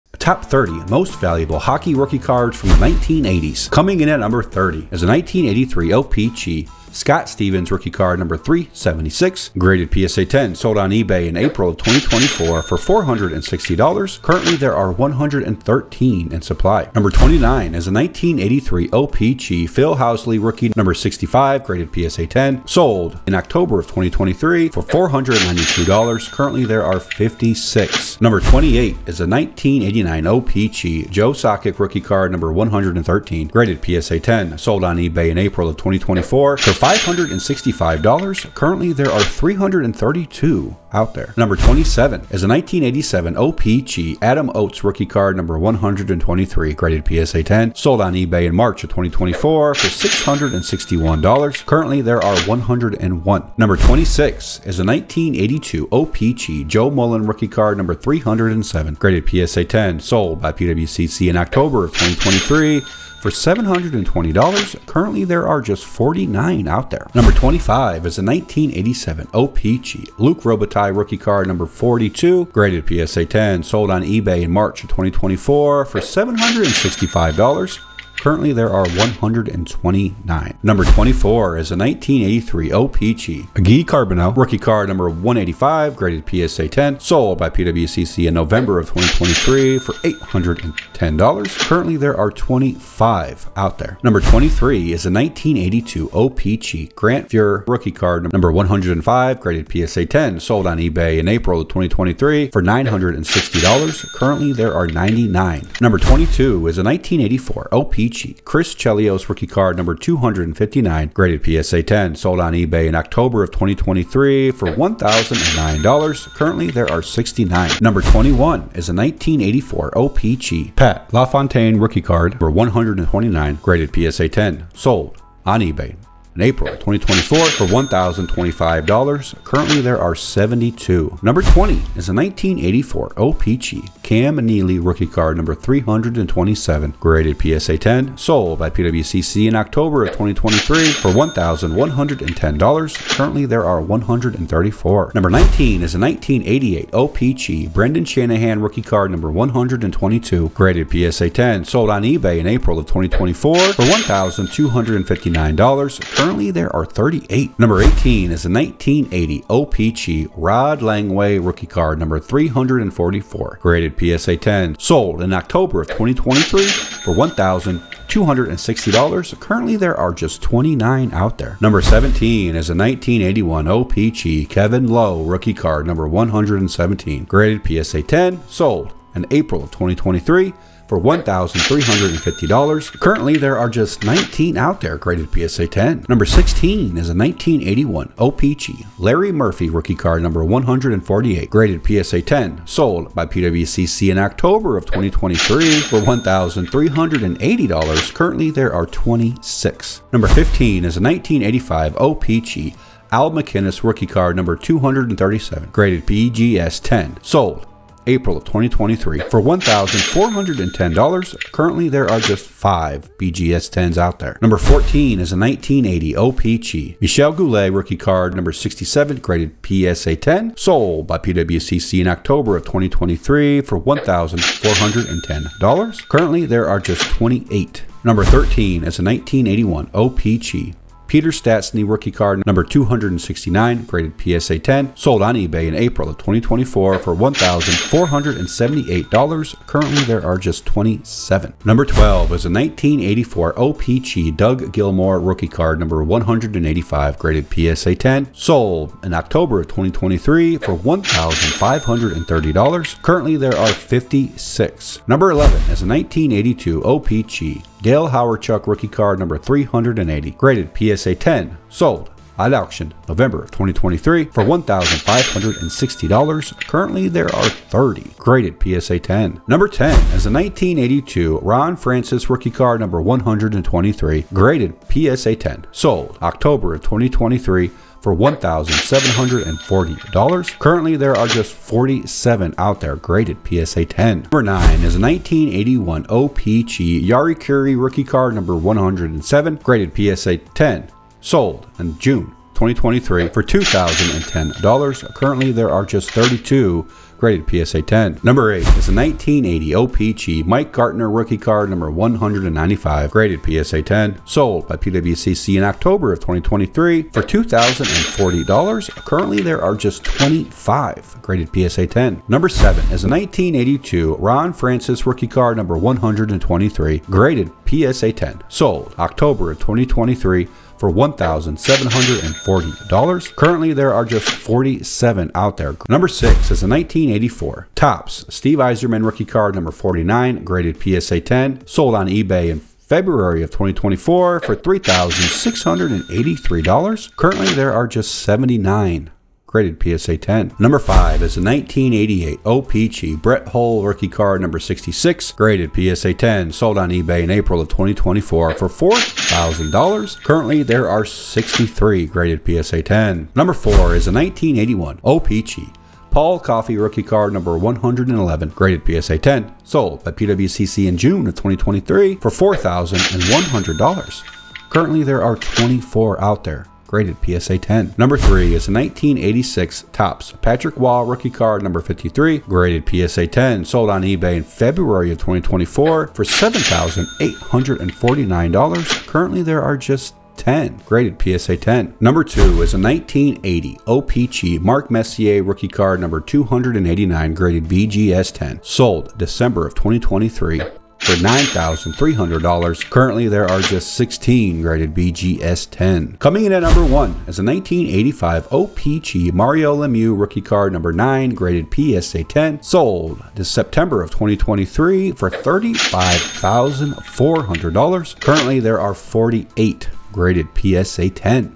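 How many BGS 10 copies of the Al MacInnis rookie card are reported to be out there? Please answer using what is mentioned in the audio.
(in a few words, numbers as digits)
5.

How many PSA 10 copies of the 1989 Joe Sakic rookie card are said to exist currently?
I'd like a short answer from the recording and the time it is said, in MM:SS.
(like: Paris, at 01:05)
332, at 00:39.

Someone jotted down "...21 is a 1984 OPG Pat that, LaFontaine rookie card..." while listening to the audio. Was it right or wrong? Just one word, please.
right.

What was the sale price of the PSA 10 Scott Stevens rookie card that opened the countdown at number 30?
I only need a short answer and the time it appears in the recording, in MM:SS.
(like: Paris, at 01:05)
$460, at 00:12.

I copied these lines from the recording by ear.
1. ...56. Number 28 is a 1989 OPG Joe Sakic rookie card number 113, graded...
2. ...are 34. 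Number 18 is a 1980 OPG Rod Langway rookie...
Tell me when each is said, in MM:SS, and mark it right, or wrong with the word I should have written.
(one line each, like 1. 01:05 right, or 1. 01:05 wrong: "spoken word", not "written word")
1. 00:26 right
2. 02:36 wrong: "38", not "34".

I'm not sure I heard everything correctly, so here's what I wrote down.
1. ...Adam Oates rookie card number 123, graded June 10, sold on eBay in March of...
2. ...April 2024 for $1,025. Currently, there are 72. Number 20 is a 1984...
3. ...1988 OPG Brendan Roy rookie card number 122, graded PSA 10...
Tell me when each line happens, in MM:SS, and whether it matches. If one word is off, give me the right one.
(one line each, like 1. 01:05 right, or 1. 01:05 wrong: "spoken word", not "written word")
1. 00:44 wrong: "PSA", not "June"
2. 02:06 right
3. 02:25 wrong: "Shanahan", not "Roy".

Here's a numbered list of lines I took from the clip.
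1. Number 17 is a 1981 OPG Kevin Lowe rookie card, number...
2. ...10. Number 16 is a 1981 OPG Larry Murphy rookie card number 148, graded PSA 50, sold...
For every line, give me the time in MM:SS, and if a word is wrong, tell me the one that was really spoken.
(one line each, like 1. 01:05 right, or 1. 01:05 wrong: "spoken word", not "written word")
1. 02:51 right
2. 03:05 wrong: "10", not "50".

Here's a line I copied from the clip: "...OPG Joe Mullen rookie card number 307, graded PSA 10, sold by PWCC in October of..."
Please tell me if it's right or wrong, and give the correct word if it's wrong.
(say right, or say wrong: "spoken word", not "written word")
right.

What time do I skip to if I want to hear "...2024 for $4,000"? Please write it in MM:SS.
05:47.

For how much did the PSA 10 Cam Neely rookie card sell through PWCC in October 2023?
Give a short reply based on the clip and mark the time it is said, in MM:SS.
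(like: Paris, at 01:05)
$1,110, at 02:21.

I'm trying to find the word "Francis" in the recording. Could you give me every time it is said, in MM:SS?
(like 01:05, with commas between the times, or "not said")
04:31, 05:14.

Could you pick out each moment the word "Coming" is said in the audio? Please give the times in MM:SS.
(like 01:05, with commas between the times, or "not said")
00:03, 06:36.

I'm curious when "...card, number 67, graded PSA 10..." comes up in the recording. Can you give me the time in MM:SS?
03:37.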